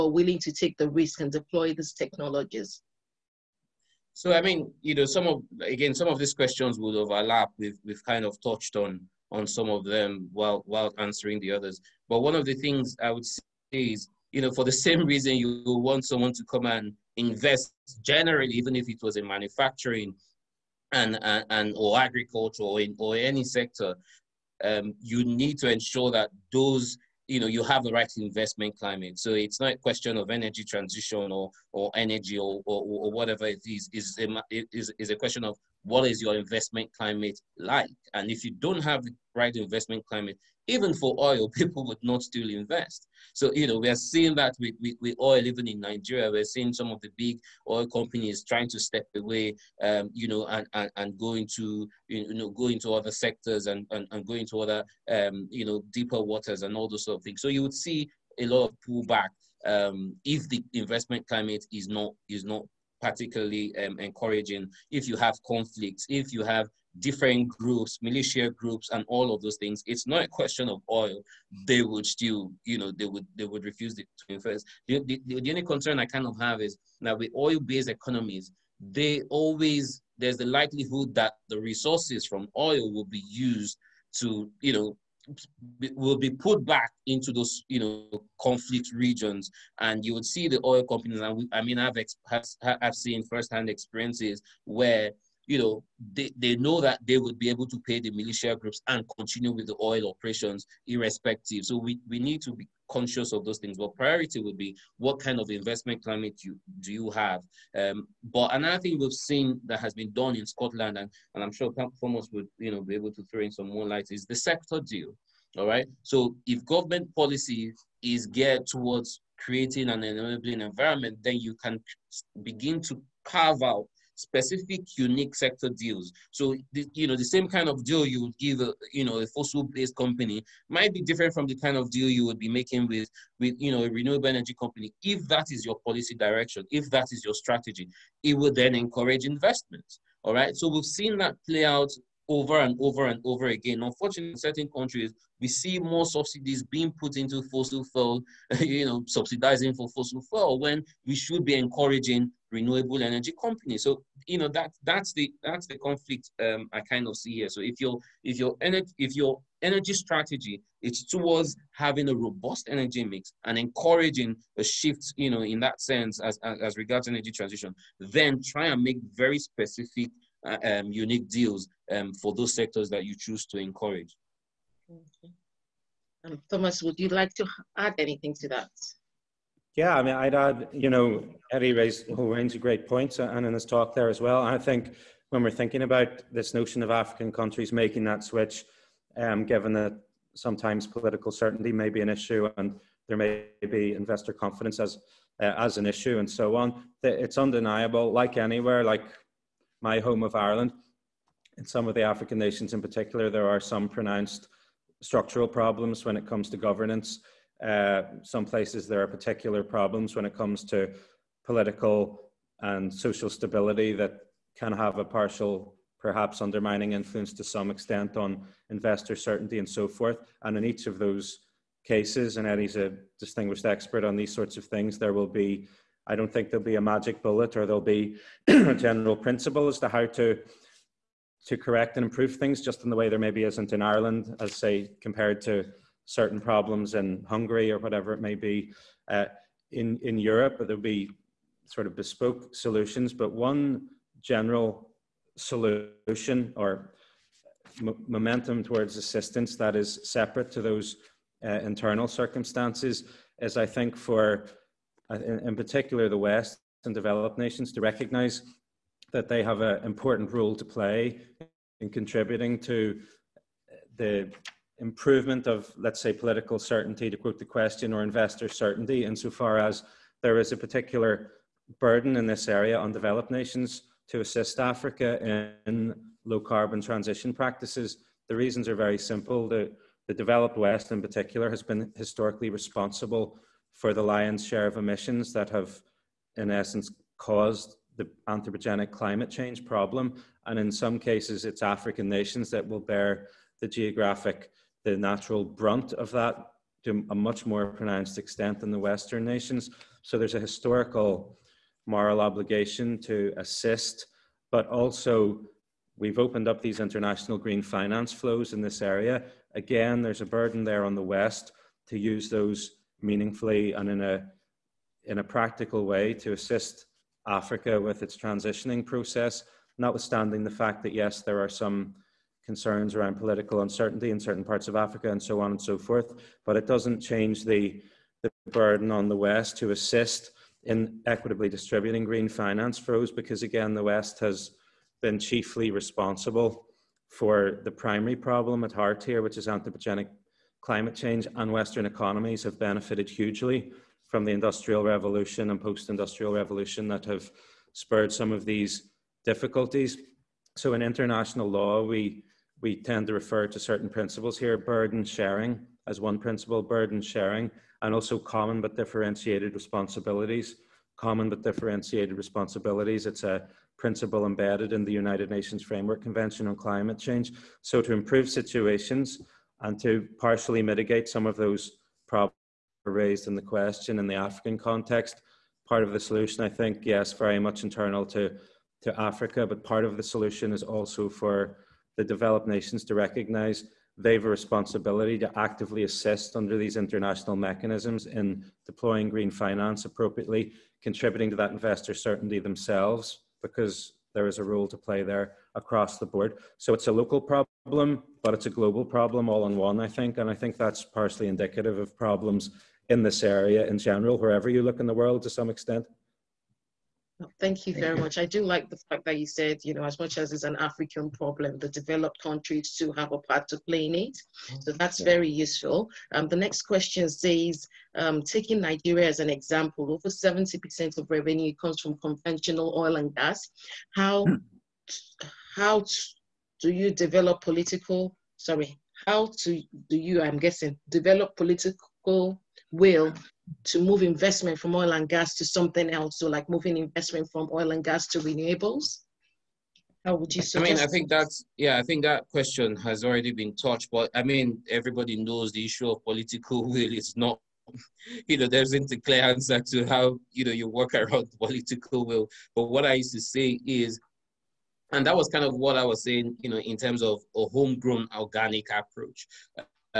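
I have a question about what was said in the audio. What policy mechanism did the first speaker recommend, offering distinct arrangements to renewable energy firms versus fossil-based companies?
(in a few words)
Sector deal.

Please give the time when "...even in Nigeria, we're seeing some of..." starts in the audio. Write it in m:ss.
0:45.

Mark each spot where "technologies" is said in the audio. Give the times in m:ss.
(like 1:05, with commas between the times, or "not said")
0:01.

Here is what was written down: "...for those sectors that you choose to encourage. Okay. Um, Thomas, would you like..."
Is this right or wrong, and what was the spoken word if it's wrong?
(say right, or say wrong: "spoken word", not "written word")
right.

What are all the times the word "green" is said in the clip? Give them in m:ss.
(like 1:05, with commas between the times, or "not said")
5:07, 5:32, 6:29.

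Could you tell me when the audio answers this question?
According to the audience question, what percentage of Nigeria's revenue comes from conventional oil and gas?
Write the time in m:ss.
6:59.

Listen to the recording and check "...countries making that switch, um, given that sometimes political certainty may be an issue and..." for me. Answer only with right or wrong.
right.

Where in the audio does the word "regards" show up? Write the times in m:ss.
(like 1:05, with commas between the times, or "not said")
2:46.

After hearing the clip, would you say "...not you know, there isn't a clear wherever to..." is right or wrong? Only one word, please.
wrong.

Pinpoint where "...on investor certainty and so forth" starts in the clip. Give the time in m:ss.
3:38.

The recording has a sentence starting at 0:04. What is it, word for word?
So, I mean, you know, some of, again, some of these questions would overlap.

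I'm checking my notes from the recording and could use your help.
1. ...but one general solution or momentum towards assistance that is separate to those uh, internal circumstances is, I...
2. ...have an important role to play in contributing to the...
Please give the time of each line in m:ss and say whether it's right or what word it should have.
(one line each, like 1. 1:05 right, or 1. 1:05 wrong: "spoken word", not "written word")
1. 4:03 right
2. 4:19 right.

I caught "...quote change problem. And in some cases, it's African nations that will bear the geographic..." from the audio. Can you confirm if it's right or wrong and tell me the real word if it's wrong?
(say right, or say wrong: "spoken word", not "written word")
wrong: "climate", not "quote".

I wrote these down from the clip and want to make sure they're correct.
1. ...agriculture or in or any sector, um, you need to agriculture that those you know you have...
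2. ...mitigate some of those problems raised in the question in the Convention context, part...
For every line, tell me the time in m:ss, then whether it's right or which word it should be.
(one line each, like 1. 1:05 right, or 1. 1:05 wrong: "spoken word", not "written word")
1. 0:21 wrong: "ensure", not "agriculture"
2. 6:10 wrong: "African", not "Convention".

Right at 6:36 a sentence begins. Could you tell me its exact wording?
So it's a local problem, but it's a global problem all in one, I think.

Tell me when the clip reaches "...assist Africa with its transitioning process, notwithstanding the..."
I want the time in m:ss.
5:16.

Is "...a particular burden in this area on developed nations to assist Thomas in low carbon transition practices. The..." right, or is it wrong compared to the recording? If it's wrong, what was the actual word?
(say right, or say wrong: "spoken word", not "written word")
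wrong: "Africa", not "Thomas".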